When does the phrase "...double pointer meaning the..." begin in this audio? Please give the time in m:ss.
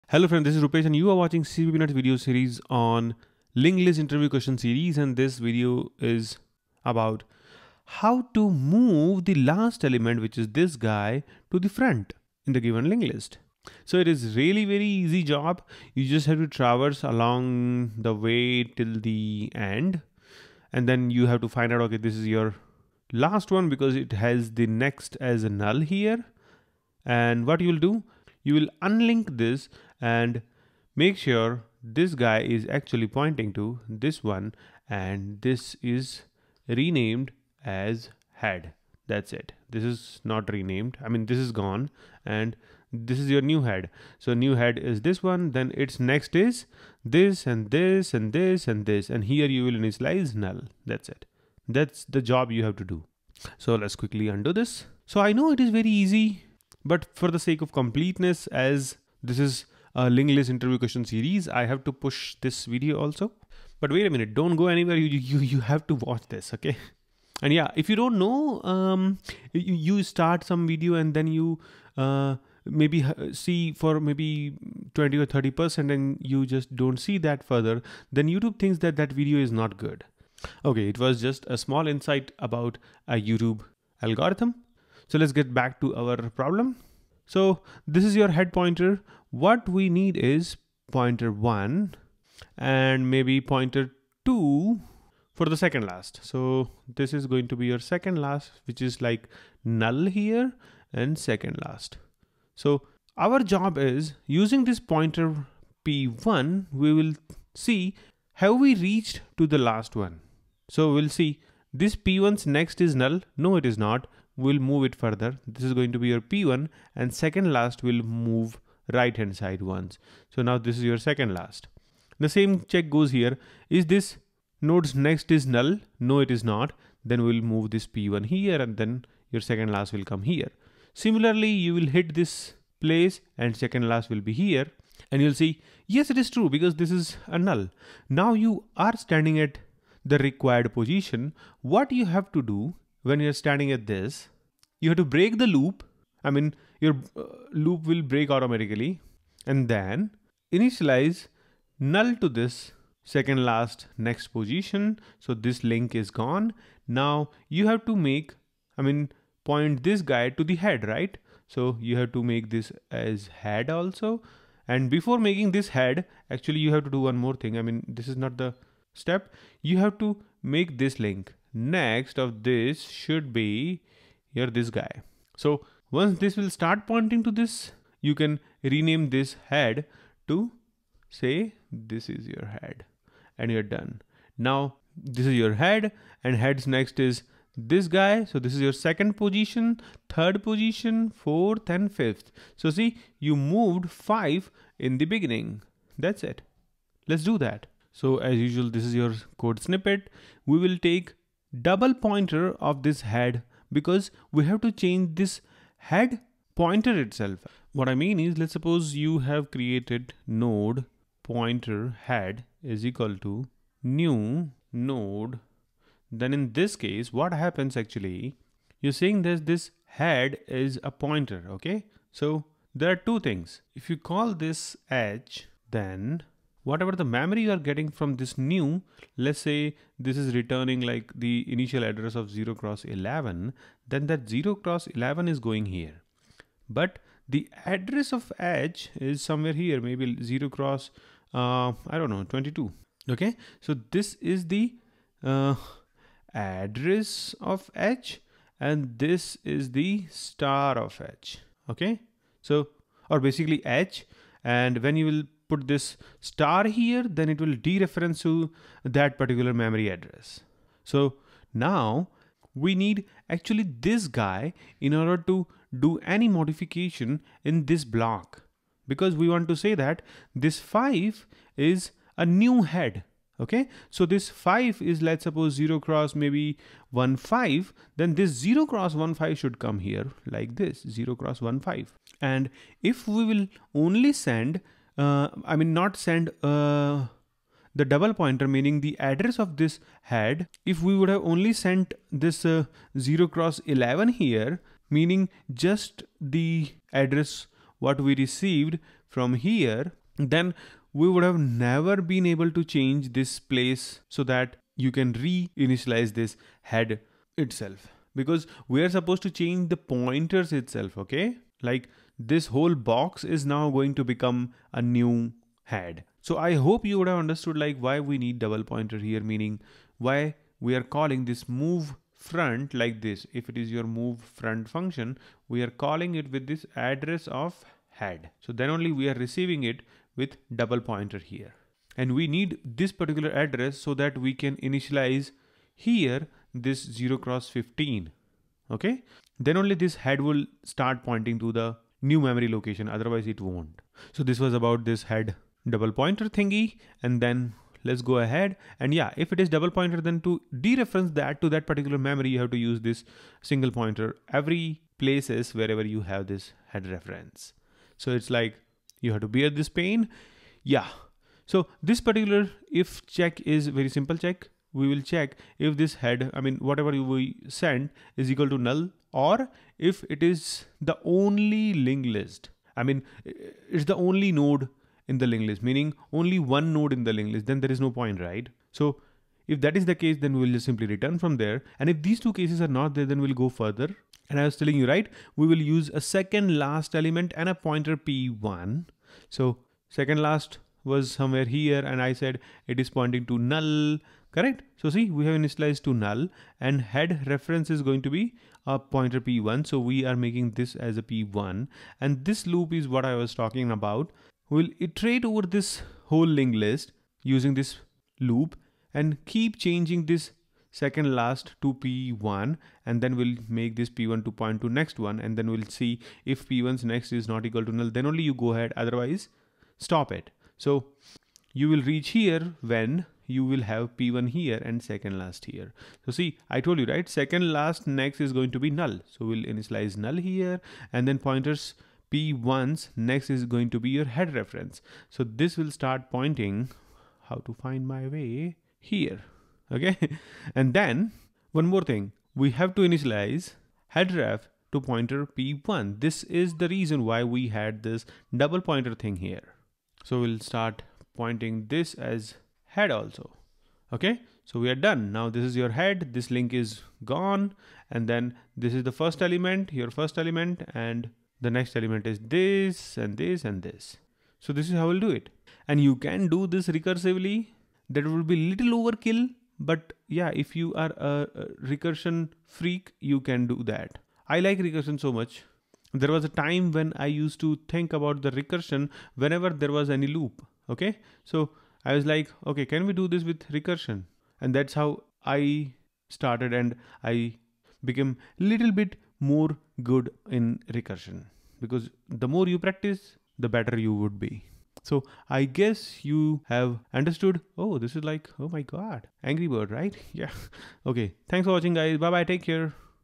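4:47.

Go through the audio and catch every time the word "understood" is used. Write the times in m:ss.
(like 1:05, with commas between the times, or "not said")
5:17, 8:16.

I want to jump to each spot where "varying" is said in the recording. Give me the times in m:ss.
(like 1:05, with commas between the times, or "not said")
not said.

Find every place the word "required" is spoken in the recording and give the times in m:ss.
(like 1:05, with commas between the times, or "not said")
2:20.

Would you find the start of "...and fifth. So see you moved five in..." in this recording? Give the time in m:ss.
3:11.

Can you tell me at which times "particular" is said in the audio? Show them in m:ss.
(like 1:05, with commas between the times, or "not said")
4:19, 5:32, 5:51, 6:02.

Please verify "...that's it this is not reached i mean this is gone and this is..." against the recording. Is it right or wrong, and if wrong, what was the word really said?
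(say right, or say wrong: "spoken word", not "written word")
wrong: "renamed", not "reached".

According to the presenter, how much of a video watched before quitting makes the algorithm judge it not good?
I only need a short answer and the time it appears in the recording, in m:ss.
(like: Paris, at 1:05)
20 or 30 percent, at 1:14.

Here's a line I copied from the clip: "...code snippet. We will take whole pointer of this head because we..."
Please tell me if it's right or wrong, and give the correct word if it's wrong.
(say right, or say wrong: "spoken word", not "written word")
wrong: "double", not "whole".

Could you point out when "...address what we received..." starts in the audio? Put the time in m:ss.
4:56.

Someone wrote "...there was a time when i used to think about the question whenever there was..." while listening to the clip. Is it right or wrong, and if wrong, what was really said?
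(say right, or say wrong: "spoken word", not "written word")
wrong: "recursion", not "question".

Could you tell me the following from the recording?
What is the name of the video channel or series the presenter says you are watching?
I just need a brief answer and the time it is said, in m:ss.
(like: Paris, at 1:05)
CppNuts, at 0:01.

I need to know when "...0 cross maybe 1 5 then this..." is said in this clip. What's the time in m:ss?
4:35.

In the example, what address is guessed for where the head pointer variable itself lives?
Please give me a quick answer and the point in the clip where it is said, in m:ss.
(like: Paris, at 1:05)
0x22, at 4:00.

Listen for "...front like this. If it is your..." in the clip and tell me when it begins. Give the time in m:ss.
5:22.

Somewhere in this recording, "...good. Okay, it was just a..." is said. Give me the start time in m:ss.
1:19.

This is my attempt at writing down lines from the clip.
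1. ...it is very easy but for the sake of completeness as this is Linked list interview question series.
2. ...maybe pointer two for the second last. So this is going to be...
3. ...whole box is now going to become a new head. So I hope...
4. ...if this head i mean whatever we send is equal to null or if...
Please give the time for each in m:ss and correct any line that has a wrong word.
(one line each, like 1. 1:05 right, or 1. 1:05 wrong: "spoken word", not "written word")
1. 0:55 right
2. 1:33 right
3. 5:12 right
4. 6:05 right.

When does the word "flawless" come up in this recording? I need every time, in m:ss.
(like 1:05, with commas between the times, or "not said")
not said.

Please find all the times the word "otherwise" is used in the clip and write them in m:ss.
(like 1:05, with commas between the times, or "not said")
5:42, 6:58.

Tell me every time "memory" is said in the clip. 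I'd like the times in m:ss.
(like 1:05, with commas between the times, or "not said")
3:47, 4:19, 5:42, 5:51.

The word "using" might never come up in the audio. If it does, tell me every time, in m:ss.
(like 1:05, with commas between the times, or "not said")
1:44, 6:47.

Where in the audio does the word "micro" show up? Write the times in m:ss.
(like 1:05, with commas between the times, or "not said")
not said.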